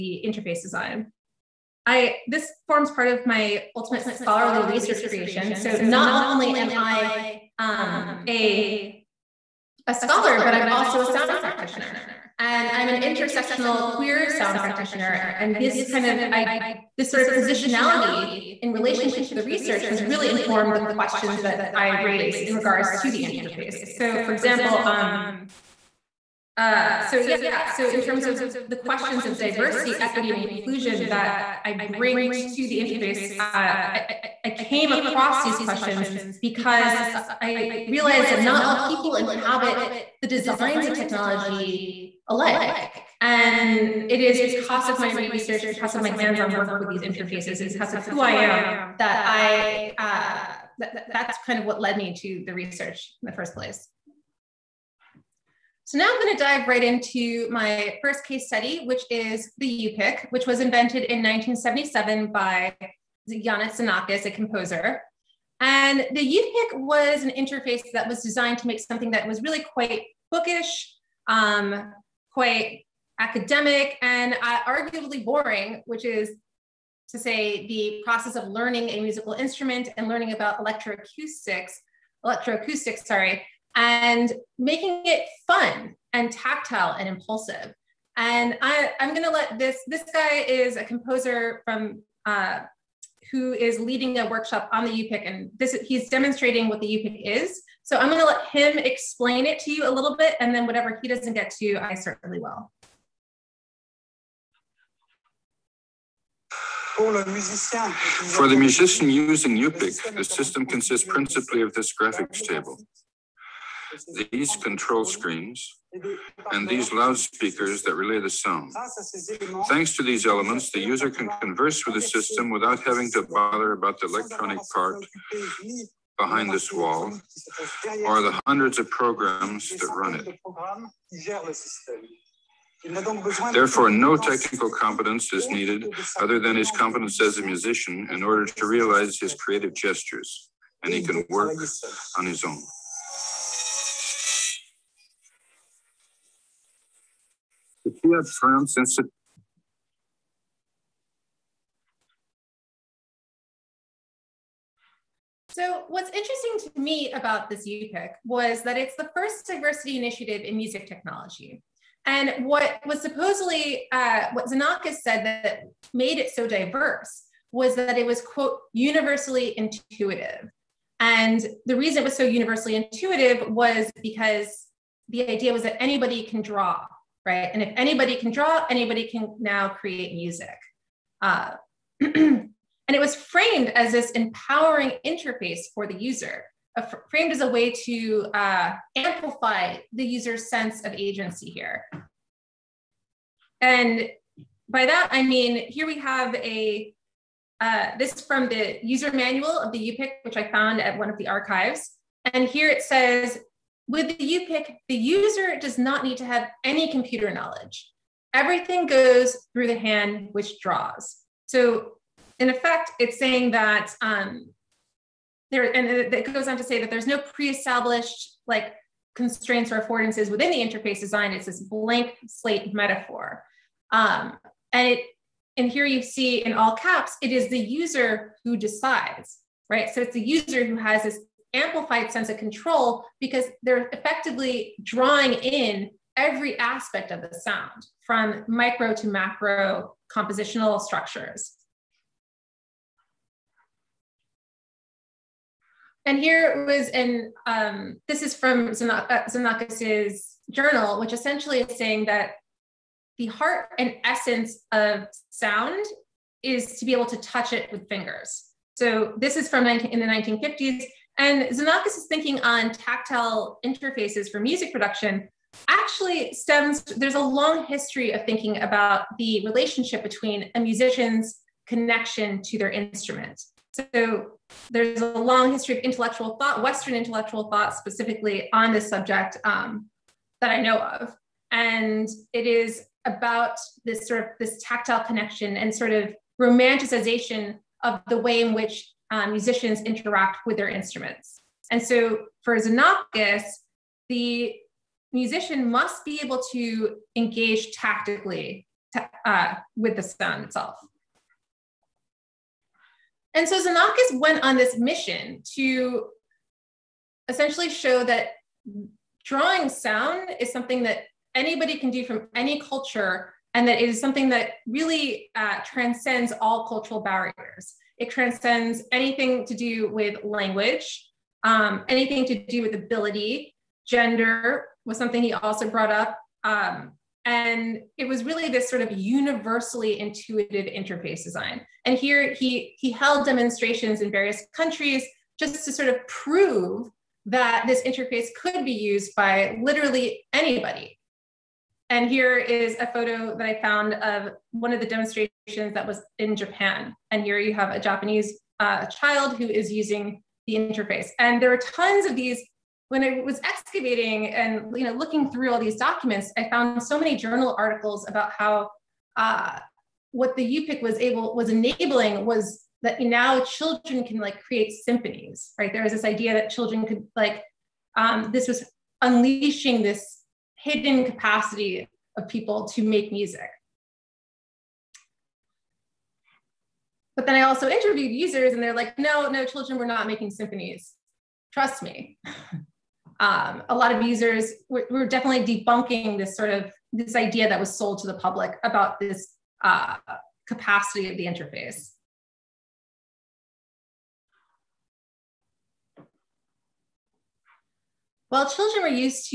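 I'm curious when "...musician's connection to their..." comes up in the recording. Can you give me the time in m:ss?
4:30.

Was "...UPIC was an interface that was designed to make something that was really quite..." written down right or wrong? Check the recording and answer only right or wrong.
right.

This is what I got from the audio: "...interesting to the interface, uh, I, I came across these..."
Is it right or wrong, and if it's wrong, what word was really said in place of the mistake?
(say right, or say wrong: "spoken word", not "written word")
wrong: "bring", not "interesting".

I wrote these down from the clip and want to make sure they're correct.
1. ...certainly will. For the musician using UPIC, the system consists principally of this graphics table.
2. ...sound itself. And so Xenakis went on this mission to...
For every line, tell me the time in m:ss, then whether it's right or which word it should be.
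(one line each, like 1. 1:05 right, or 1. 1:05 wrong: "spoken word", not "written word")
1. 1:41 right
2. 5:00 right.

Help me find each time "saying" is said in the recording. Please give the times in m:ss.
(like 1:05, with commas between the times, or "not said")
3:33, 4:11.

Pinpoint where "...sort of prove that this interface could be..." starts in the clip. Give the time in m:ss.
5:35.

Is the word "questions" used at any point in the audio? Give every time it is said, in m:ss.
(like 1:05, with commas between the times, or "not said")
0:20, 0:28, 0:35.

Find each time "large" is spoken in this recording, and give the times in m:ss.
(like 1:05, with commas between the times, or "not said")
not said.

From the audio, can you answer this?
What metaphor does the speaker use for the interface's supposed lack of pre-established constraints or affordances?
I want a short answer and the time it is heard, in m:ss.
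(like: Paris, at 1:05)
blank slate, at 3:41.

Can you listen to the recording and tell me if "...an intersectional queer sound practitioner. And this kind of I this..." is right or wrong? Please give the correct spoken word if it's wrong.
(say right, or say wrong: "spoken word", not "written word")
right.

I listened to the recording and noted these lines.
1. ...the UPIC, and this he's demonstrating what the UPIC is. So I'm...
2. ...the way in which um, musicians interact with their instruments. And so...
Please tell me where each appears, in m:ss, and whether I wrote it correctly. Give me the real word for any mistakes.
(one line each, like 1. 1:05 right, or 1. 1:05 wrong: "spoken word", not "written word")
1. 1:34 right
2. 4:48 right.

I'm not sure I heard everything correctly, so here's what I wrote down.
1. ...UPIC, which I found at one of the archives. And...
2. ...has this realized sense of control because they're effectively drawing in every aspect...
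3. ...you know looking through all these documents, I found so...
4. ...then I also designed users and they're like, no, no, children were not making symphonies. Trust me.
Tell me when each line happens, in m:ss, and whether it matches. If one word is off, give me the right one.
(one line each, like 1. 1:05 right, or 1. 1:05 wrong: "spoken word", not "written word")
1. 3:19 right
2. 3:50 wrong: "amplified", not "realized"
3. 5:54 right
4. 6:17 wrong: "interviewed", not "designed".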